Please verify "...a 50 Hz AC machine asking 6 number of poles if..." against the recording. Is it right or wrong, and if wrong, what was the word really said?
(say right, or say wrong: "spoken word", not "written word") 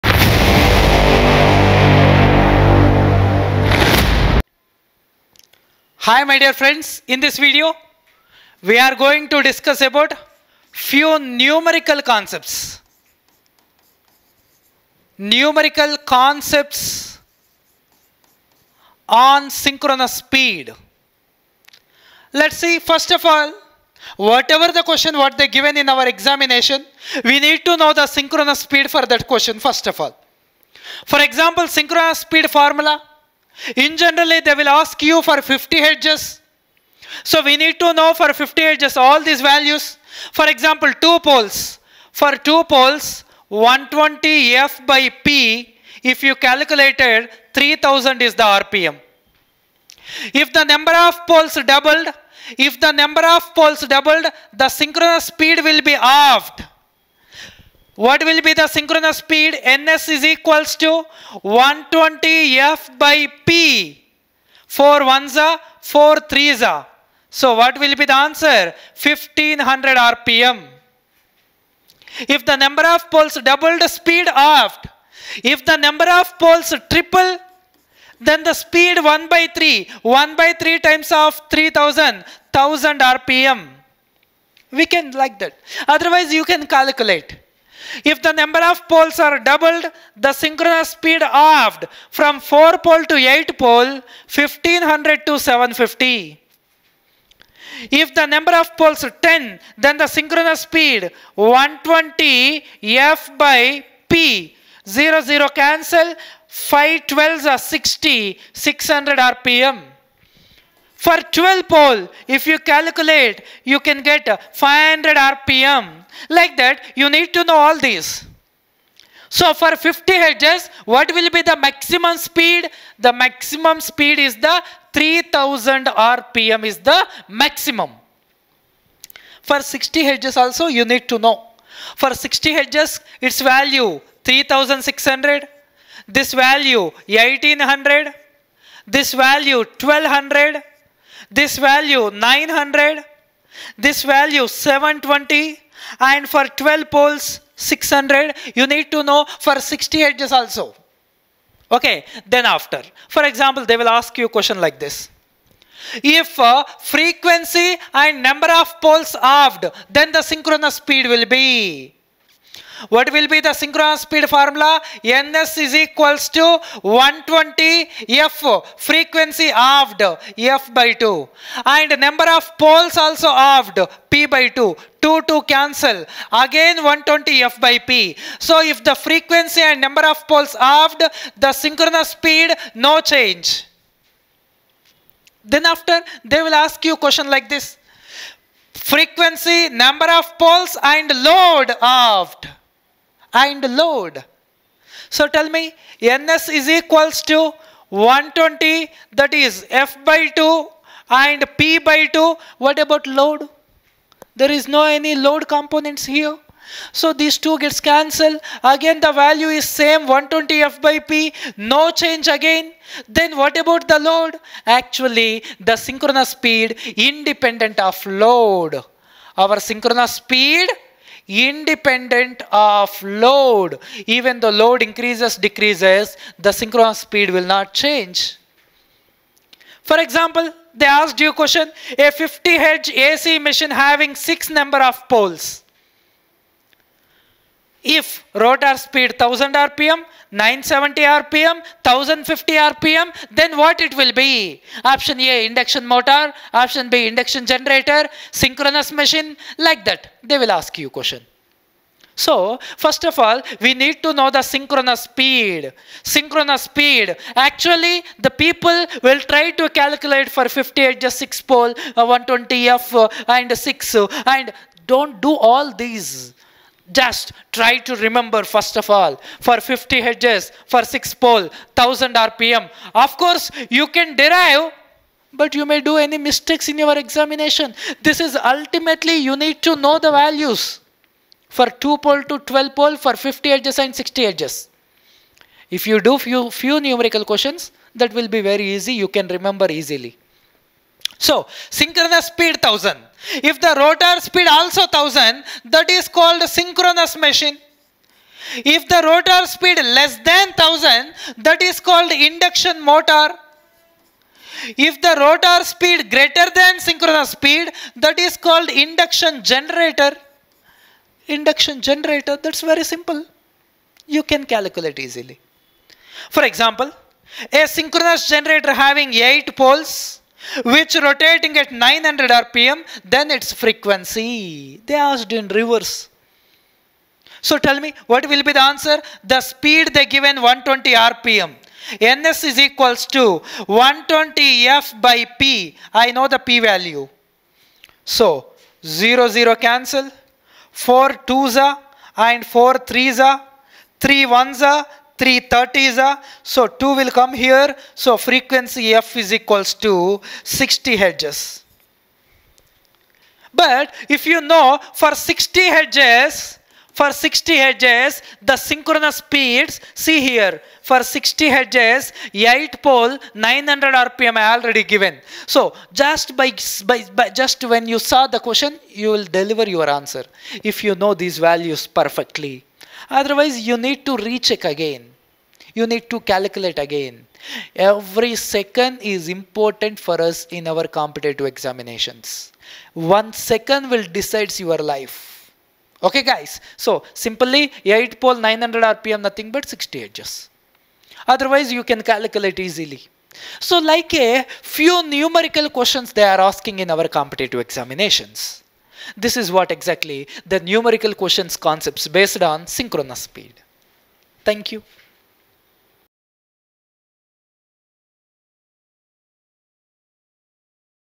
wrong: "having", not "asking".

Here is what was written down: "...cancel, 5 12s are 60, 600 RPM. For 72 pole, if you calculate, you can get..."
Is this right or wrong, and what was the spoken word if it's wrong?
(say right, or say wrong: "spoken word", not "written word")
wrong: "12", not "72".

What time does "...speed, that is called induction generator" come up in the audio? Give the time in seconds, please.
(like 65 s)
307 s.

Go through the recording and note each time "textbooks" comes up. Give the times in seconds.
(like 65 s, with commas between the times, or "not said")
not said.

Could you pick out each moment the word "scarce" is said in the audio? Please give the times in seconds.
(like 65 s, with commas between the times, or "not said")
not said.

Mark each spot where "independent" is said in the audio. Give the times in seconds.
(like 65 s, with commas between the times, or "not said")
216 s, 221 s.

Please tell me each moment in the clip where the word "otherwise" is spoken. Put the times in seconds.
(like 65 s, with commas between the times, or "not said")
85 s, 373 s, 391 s.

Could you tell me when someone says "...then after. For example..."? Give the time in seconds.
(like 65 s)
152 s.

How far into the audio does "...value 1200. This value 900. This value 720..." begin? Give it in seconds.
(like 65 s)
139 s.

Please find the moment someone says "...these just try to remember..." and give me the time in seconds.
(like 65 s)
265 s.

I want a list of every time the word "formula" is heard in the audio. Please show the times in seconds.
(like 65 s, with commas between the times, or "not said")
32 s, 164 s.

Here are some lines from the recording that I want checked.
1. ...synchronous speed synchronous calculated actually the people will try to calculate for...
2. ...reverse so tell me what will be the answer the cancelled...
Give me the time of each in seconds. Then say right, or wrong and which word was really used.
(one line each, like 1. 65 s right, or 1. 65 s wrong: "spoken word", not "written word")
1. 254 s wrong: "speed", not "calculated"
2. 325 s wrong: "speed", not "cancelled".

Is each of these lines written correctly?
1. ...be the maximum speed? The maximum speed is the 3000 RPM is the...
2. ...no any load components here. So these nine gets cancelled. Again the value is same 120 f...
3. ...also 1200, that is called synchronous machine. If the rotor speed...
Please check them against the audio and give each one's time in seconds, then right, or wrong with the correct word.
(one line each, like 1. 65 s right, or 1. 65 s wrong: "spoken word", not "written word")
1. 121 s right
2. 204 s wrong: "two", not "nine"
3. 294 s wrong: "1000", not "1200".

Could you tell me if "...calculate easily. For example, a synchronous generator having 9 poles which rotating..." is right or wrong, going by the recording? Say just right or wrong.
wrong.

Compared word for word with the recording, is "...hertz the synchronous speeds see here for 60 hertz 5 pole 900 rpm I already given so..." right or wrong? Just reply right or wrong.
wrong.